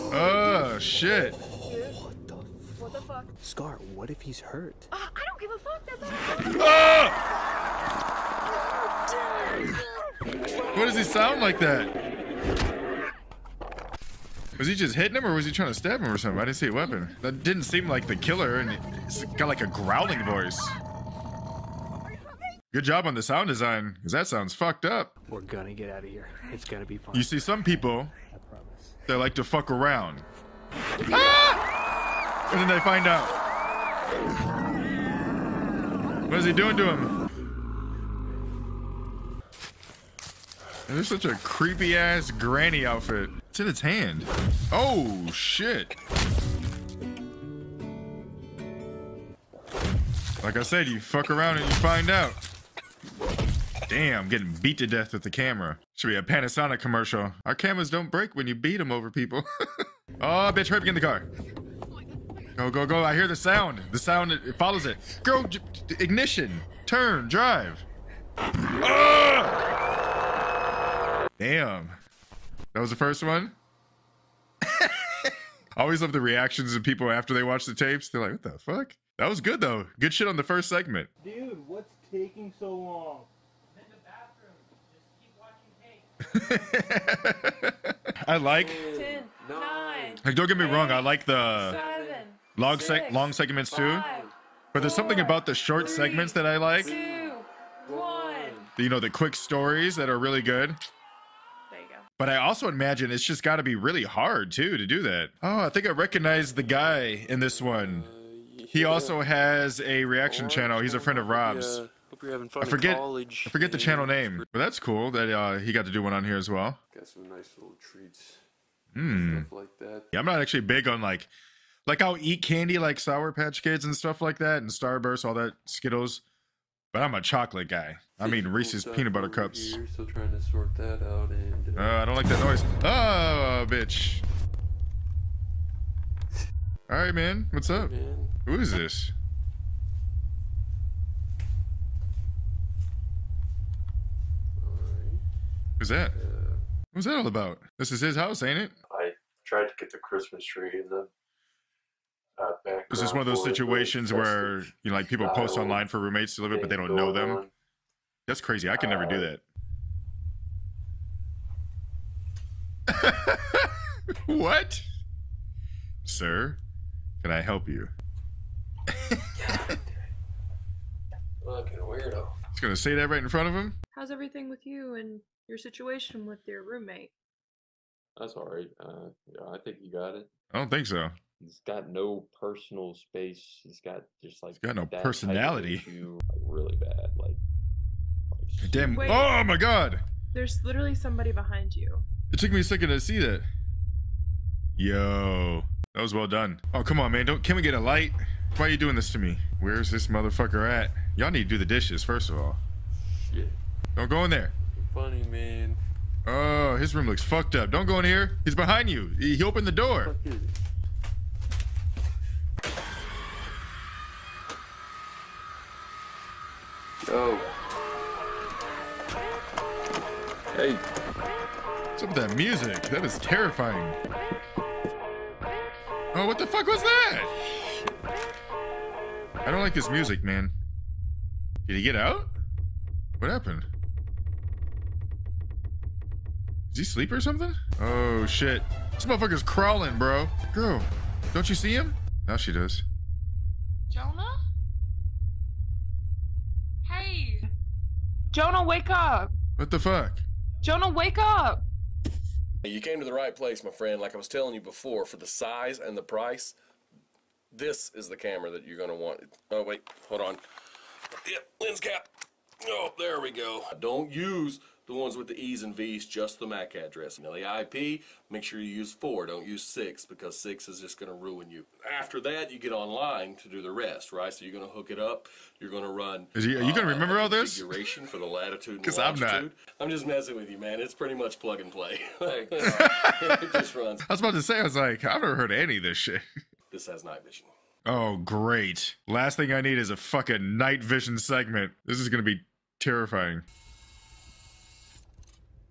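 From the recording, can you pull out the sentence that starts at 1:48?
He also has a reaction channel.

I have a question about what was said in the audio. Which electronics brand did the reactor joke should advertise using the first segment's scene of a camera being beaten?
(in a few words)
Panasonic.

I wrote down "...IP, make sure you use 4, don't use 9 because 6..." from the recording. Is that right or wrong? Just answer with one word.
wrong.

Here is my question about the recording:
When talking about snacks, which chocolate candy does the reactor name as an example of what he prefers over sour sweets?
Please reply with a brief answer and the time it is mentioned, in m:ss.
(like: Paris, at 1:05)
Reese's peanut butter cups, at 2:08.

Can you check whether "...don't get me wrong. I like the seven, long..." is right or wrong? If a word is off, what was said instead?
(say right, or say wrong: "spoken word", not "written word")
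right.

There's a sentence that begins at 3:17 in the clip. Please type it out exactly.
Don't can we get a light?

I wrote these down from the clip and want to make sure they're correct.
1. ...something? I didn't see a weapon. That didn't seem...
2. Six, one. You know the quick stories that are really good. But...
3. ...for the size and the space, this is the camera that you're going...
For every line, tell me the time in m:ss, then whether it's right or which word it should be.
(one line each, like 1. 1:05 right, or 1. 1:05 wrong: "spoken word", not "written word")
1. 0:16 right
2. 1:36 wrong: "Two", not "Six"
3. 4:15 wrong: "price", not "space".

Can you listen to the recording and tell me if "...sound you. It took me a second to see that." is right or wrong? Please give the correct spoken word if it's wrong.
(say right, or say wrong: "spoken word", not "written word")
wrong: "behind", not "sound".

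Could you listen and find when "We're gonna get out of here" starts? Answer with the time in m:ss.
0:25.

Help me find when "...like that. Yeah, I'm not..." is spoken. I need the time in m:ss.
1:59.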